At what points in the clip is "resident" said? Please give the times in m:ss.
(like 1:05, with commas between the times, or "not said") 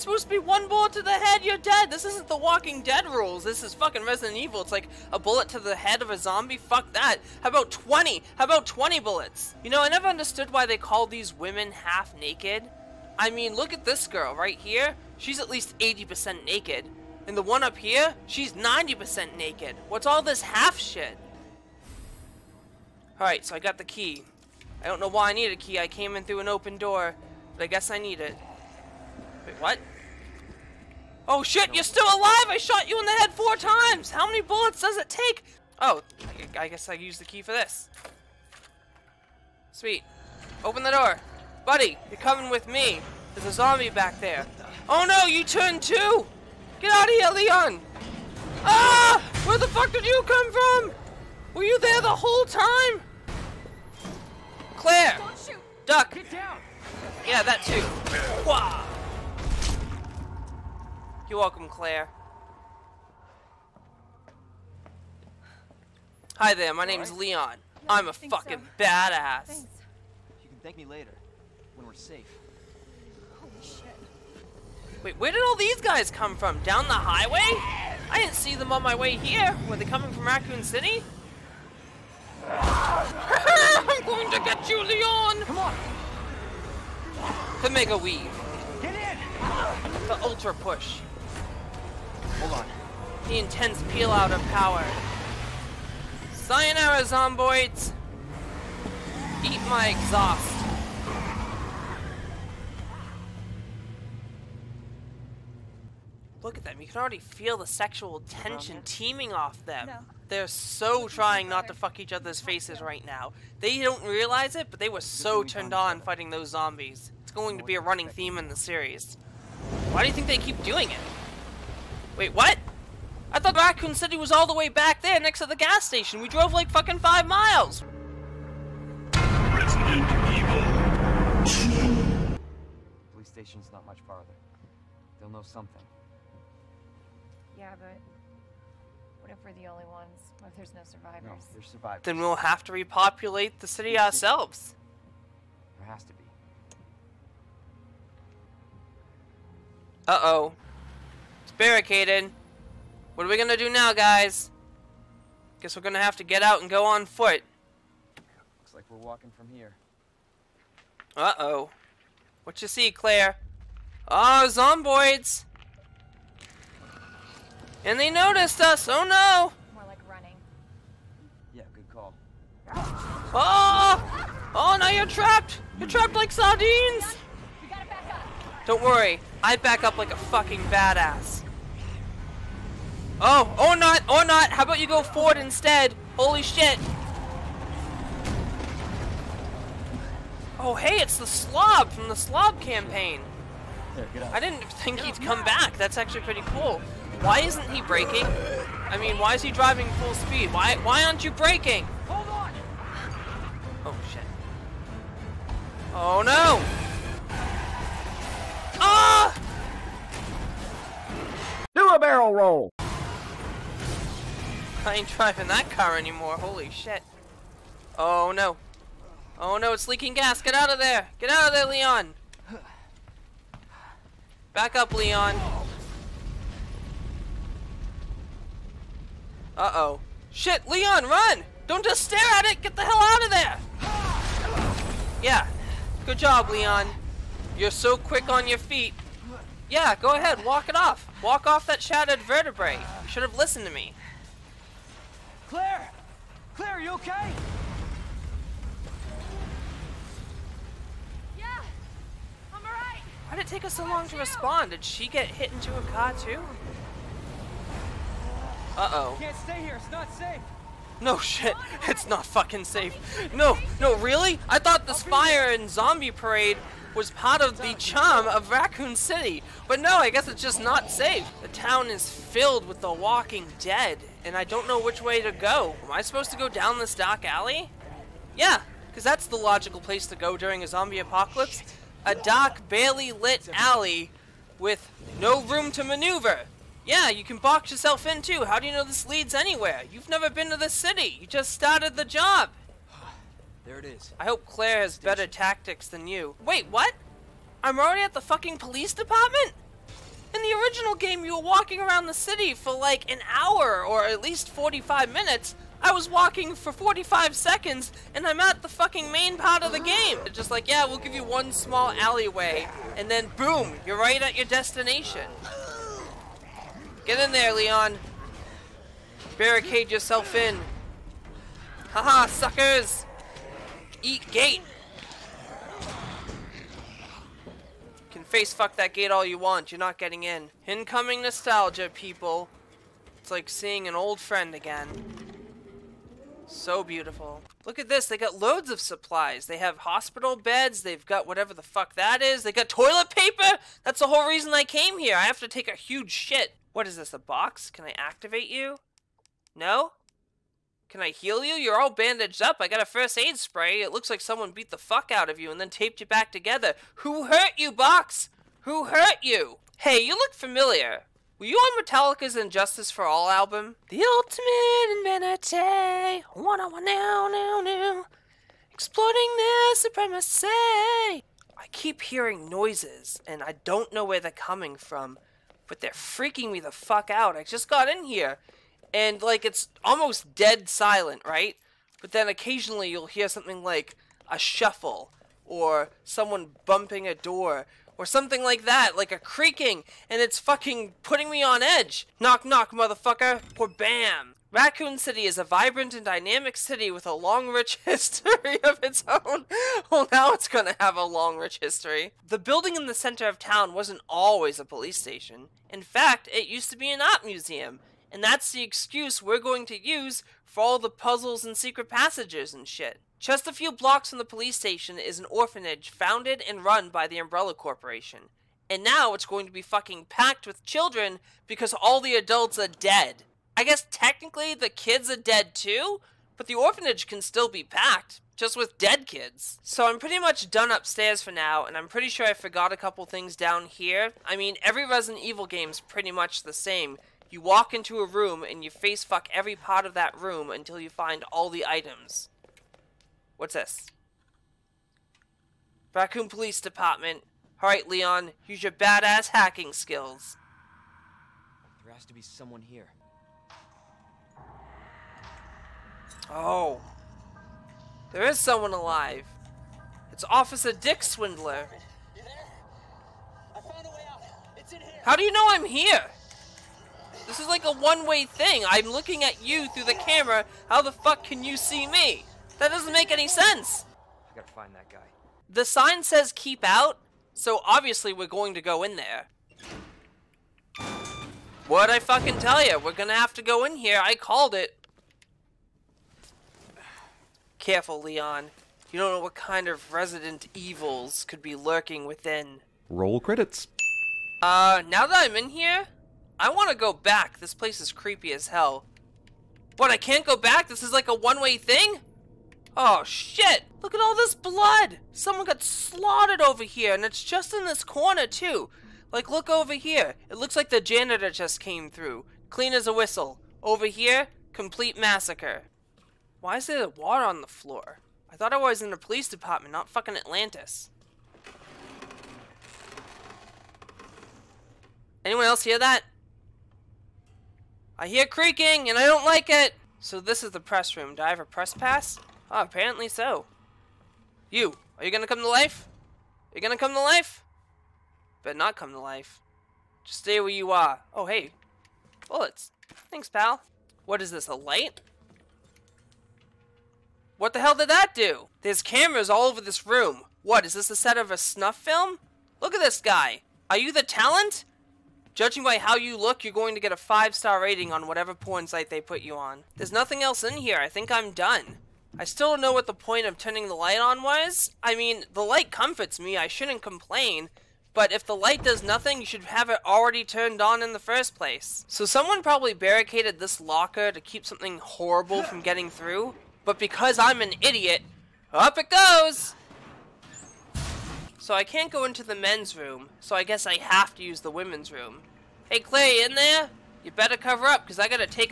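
0:04, 2:09, 7:14, 8:09.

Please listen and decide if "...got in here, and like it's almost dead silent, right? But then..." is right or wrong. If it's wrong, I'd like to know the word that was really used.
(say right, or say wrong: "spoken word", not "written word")
right.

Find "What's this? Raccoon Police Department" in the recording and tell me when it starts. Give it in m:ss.
7:23.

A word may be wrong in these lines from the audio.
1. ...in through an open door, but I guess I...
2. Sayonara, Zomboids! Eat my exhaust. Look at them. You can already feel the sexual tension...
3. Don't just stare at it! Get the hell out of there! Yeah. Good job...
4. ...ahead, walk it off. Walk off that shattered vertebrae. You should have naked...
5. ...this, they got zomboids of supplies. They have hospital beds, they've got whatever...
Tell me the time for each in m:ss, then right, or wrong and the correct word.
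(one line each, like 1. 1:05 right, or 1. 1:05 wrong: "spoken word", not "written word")
1. 0:26 right
2. 1:36 right
3. 3:51 right
4. 4:00 wrong: "listened", not "naked"
5. 5:37 wrong: "loads", not "zomboids".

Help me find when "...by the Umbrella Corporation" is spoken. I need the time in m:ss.
6:56.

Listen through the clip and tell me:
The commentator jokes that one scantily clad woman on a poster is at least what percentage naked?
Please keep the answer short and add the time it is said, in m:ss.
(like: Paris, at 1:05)
80%, at 0:15.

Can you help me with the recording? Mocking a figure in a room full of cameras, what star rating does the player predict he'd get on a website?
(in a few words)
5-star.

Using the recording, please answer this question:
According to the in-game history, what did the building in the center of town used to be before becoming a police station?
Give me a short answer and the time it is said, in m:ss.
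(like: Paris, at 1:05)
An art museum, at 6:46.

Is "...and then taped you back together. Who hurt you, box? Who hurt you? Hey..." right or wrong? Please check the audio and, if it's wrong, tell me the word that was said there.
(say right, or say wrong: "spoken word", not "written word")
right.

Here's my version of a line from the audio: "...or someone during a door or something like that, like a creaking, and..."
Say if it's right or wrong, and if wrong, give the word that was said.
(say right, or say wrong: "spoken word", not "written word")
wrong: "bumping", not "during".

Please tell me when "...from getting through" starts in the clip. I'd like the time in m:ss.
9:35.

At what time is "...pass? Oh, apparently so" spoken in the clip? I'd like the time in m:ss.
8:51.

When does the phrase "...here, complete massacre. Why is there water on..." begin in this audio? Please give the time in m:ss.
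8:33.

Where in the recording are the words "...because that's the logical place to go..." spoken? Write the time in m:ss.
4:38.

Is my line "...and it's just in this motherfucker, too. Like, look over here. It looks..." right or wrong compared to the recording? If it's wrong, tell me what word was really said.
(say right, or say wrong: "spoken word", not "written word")
wrong: "corner", not "motherfucker".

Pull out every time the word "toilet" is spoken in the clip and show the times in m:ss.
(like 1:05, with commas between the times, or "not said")
5:42.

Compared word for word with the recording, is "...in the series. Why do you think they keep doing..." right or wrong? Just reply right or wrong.
right.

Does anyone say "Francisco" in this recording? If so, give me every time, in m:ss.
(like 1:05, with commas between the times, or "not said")
not said.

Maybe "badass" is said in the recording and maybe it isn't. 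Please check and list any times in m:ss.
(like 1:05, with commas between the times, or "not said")
1:08, 3:00, 7:28.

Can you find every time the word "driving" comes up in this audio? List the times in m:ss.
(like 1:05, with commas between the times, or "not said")
3:19, 3:35.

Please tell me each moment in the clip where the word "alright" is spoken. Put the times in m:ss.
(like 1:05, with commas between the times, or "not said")
0:23, 4:12, 7:27.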